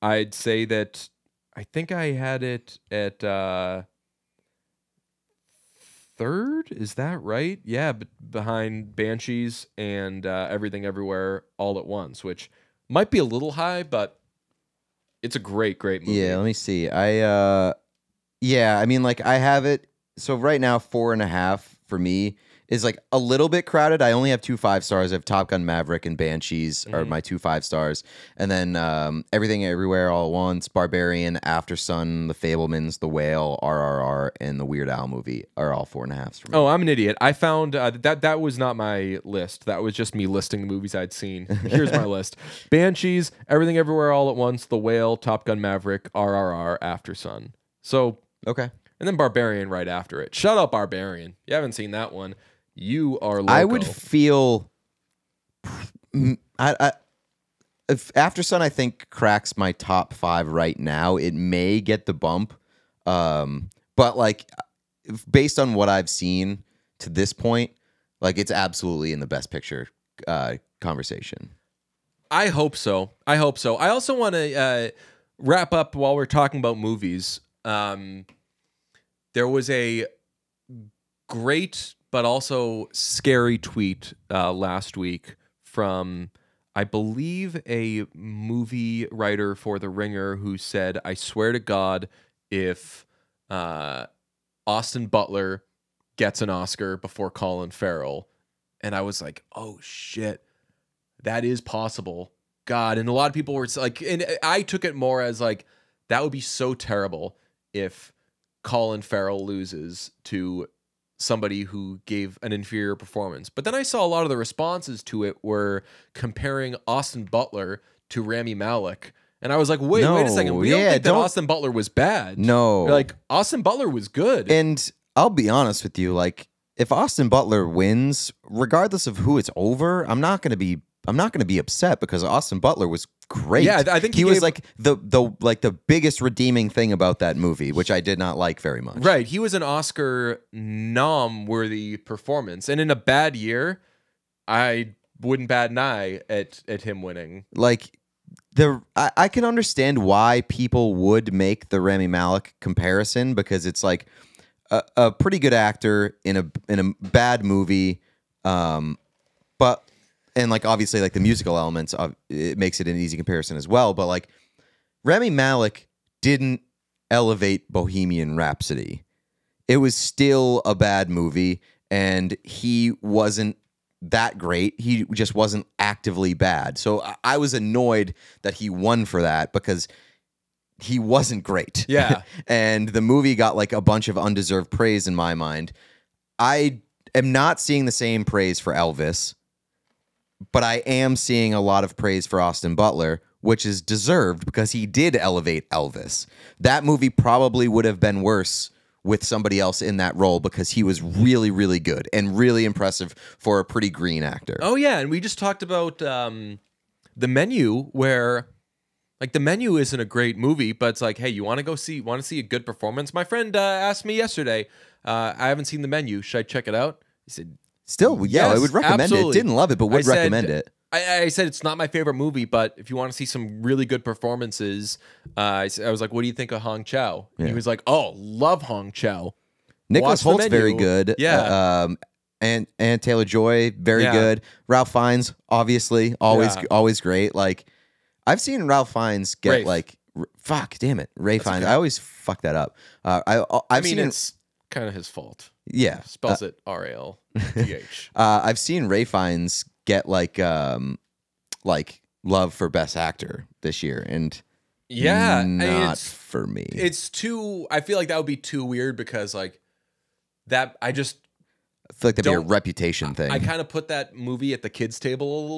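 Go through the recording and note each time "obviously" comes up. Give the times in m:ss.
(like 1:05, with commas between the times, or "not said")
2:40, 3:55.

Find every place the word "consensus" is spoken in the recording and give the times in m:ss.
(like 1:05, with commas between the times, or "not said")
not said.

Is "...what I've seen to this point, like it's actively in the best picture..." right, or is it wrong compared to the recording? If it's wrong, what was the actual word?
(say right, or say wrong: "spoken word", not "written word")
wrong: "absolutely", not "actively".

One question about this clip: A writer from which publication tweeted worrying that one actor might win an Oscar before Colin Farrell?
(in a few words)
The Ringer.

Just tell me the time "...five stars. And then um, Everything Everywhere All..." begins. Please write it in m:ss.
0:27.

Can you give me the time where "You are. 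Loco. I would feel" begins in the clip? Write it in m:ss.
0:52.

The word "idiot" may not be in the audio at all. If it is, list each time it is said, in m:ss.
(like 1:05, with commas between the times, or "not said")
0:36.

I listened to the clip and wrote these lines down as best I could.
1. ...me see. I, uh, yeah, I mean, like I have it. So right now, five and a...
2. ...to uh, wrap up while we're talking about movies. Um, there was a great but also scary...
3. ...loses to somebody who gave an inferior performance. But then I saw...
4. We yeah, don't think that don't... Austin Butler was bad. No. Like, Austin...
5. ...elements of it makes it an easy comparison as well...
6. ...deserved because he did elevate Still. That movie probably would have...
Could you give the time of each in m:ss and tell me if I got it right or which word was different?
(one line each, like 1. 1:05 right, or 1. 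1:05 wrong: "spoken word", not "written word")
1. 0:16 wrong: "four", not "five"
2. 1:14 right
3. 1:49 right
4. 2:00 right
5. 2:41 right
6. 3:13 wrong: "Elvis", not "Still".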